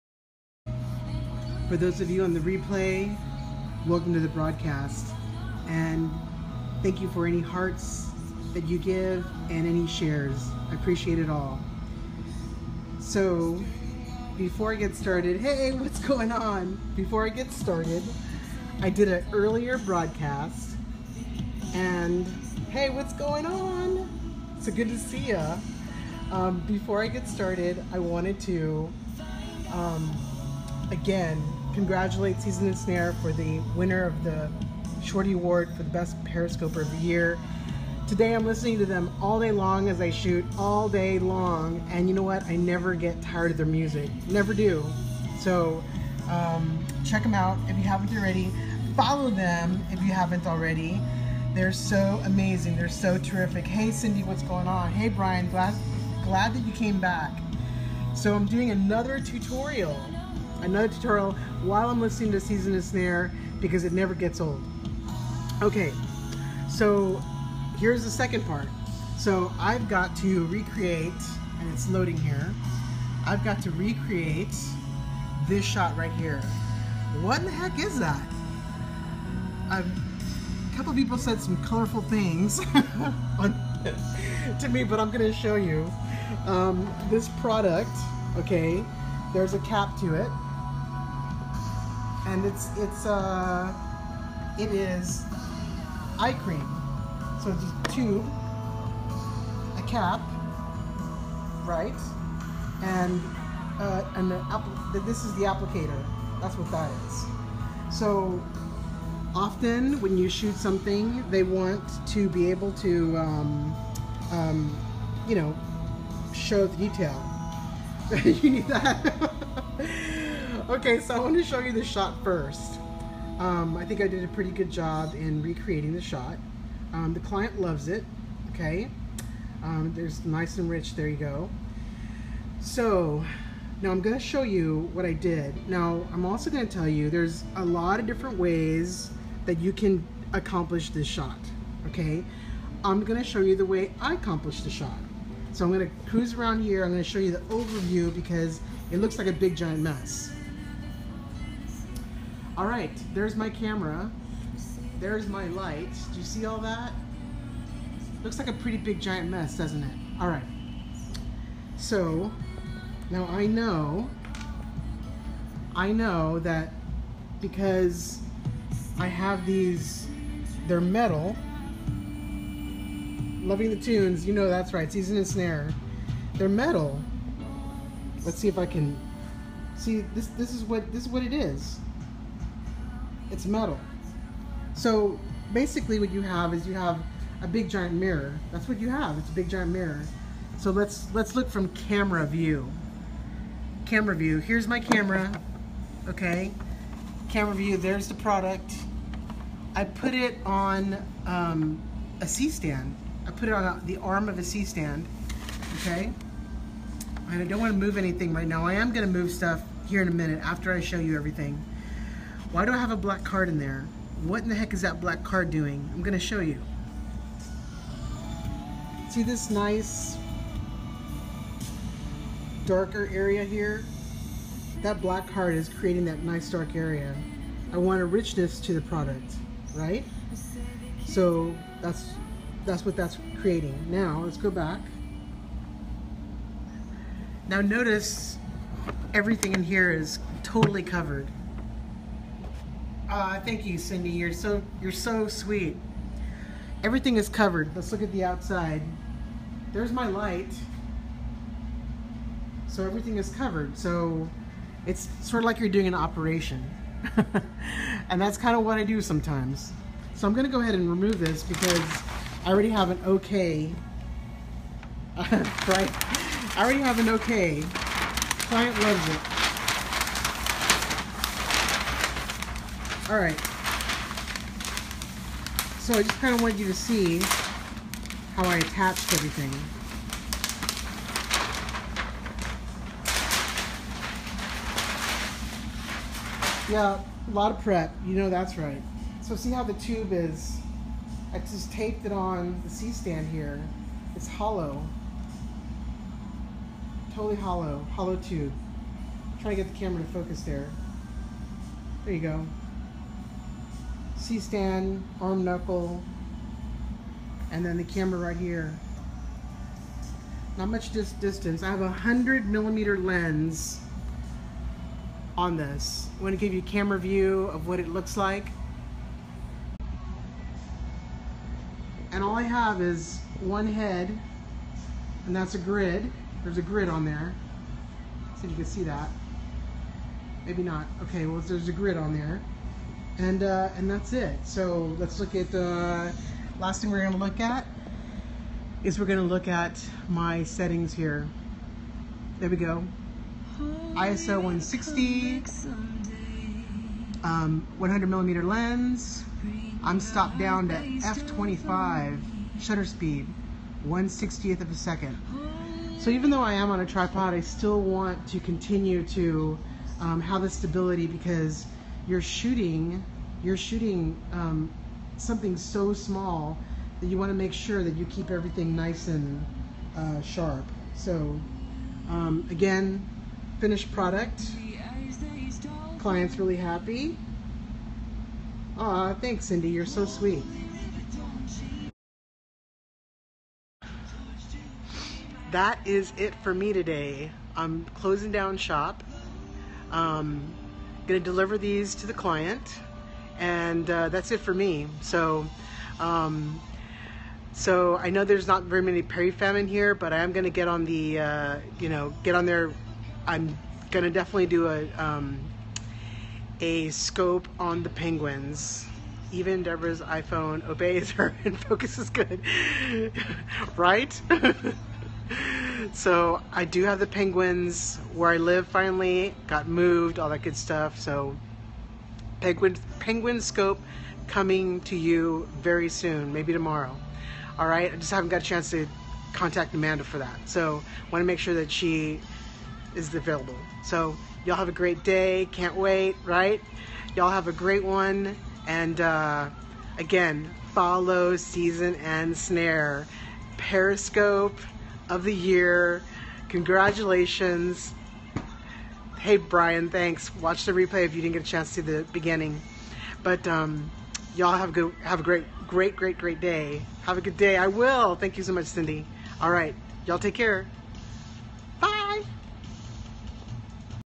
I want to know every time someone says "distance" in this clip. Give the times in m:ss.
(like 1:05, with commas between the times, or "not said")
5:11.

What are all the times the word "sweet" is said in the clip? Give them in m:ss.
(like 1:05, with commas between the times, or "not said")
4:05, 6:20.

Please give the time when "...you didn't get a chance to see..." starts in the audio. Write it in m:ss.
7:31.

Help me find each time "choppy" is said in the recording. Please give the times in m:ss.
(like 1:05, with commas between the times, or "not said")
not said.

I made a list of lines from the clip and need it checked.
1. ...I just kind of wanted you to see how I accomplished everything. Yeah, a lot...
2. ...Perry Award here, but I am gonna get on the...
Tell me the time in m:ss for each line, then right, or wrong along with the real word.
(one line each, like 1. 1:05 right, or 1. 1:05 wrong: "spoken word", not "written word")
1. 4:35 wrong: "attached", not "accomplished"
2. 6:39 wrong: "Famine", not "Award".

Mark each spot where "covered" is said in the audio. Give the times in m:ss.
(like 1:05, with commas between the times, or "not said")
4:00, 4:07, 4:13.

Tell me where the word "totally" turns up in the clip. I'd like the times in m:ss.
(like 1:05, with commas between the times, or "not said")
4:00, 4:57.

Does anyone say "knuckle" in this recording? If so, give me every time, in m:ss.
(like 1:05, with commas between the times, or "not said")
5:05.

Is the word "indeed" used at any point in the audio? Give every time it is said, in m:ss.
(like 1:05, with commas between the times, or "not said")
not said.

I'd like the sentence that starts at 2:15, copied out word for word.
Now, I'm also gonna tell you there's a lot of different ways that you can accomplish this shot, okay?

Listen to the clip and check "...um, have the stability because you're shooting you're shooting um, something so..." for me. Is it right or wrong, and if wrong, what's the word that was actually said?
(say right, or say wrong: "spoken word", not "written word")
right.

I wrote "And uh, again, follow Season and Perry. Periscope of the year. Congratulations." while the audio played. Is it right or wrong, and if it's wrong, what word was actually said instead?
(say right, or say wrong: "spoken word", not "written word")
wrong: "Snare", not "Perry".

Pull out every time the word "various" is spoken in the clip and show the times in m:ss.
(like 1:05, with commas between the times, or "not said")
not said.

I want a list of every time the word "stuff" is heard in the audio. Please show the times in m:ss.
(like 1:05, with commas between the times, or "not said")
3:29, 7:00.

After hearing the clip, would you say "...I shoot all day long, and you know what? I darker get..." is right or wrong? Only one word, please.
wrong.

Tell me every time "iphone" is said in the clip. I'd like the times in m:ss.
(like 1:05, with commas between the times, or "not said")
6:50.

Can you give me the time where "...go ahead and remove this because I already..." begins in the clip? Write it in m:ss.
4:20.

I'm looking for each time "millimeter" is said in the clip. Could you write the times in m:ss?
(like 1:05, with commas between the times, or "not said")
5:12, 5:48.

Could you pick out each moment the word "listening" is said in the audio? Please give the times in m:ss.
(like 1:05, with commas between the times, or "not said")
0:38, 1:02.